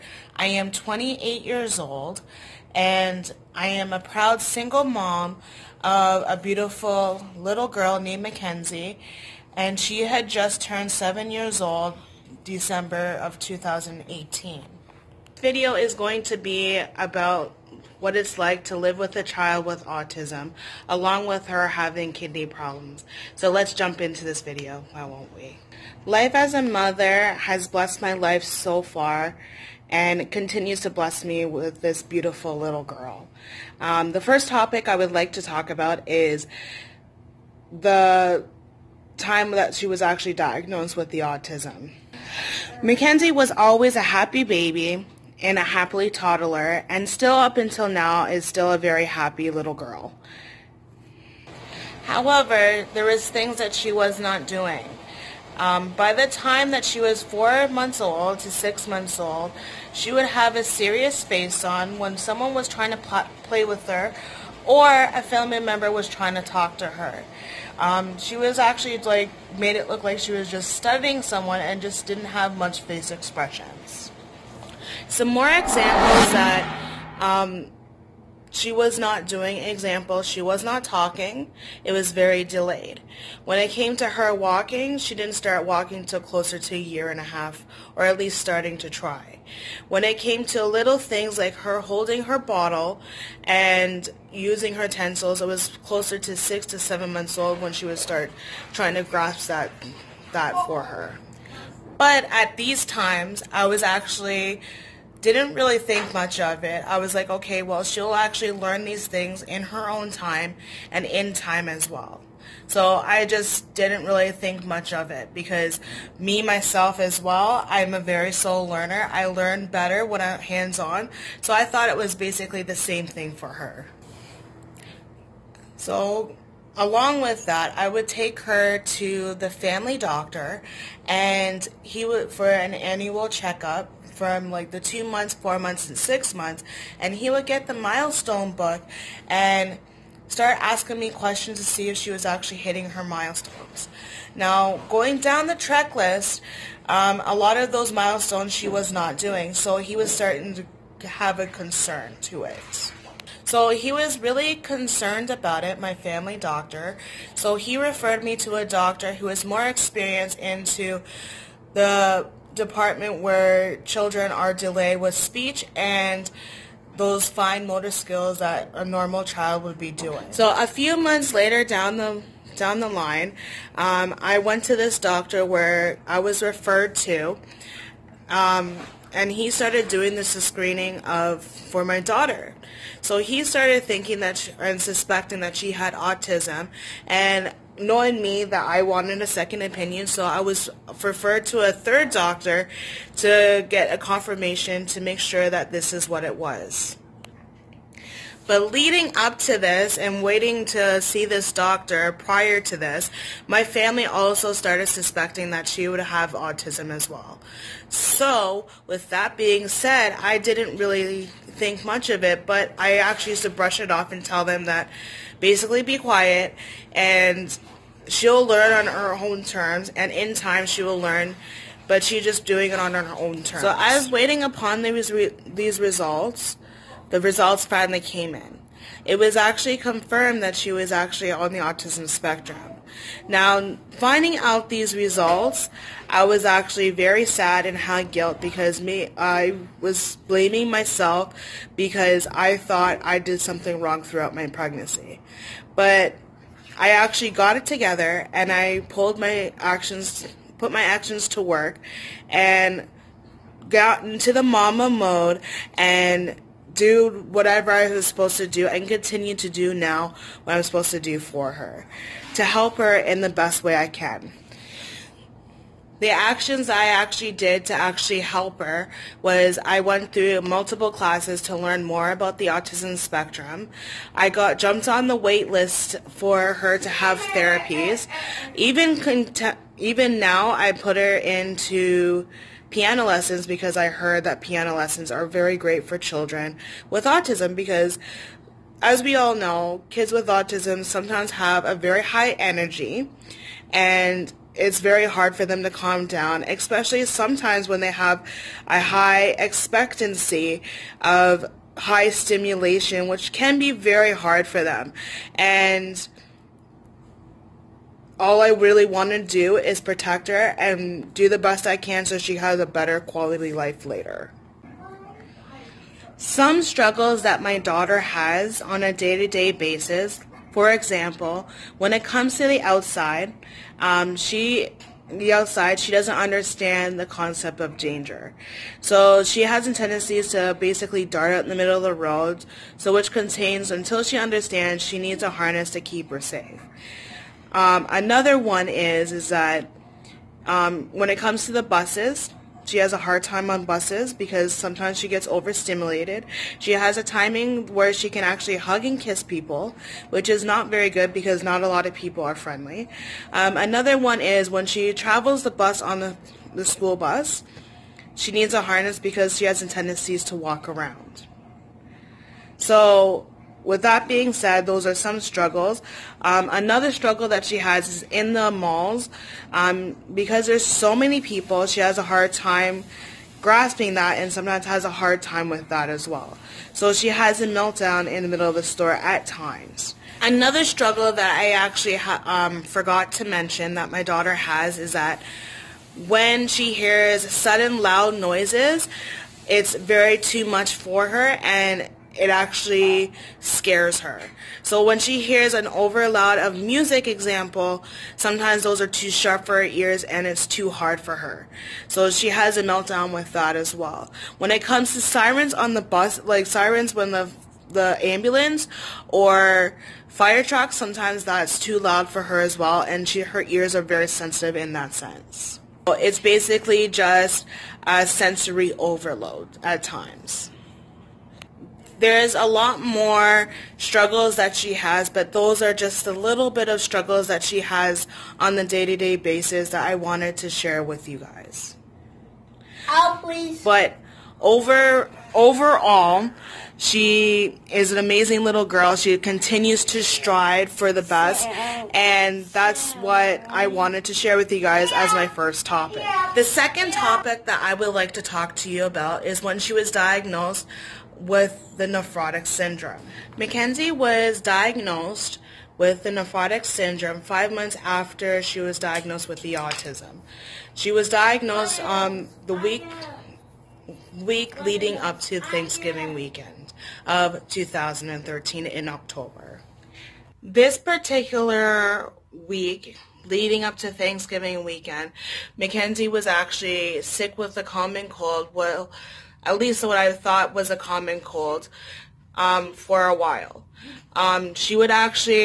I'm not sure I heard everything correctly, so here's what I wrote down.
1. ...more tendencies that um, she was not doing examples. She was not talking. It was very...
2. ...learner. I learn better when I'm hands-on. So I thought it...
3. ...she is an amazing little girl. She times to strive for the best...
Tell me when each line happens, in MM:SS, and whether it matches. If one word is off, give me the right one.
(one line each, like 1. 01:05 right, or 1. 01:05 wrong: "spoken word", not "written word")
1. 01:15 wrong: "examples", not "tendencies"
2. 01:58 right
3. 07:16 wrong: "continues", not "times".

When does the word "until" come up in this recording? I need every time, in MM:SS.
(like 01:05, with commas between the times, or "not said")
00:47, 05:33.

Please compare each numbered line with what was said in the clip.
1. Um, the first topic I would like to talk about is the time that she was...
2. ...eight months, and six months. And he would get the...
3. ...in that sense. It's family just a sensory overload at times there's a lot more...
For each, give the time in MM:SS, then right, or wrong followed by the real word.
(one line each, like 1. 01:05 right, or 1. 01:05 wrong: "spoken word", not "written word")
1. 00:33 right
2. 02:15 wrong: "four", not "eight"
3. 06:54 wrong: "basically", not "family".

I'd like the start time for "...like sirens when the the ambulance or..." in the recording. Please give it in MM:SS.
06:46.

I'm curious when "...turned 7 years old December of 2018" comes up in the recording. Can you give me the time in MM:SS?
00:10.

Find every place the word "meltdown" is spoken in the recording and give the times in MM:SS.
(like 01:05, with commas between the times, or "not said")
06:17, 06:42.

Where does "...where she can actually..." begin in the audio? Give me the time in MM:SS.
05:47.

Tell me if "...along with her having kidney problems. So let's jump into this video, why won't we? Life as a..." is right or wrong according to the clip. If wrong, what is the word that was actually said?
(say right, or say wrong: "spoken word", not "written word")
right.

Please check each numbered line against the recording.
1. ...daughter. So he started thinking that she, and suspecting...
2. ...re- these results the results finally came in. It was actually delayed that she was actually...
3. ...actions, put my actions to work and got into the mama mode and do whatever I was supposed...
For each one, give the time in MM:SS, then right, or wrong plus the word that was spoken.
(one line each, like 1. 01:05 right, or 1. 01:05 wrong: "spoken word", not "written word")
1. 03:01 right
2. 03:45 wrong: "confirmed", not "delayed"
3. 04:09 right.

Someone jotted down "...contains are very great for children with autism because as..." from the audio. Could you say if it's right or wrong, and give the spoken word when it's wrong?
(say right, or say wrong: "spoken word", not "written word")
wrong: "lessons", not "contains".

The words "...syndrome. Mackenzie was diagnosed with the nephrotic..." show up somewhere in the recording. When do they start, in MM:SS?
07:32.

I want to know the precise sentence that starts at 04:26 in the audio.
The actions I actually did to actually help her was I went through multiple classes to learn more about the autism spectrum.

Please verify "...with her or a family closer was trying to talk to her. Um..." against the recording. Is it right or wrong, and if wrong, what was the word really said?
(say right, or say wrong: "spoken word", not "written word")
wrong: "member", not "closer".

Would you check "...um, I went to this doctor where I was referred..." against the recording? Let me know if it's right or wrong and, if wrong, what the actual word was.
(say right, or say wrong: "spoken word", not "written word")
right.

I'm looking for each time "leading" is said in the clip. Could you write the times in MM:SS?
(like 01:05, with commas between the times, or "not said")
03:18, 07:44, 07:53.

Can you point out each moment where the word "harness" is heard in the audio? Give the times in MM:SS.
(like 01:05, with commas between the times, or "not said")
05:35, 05:58.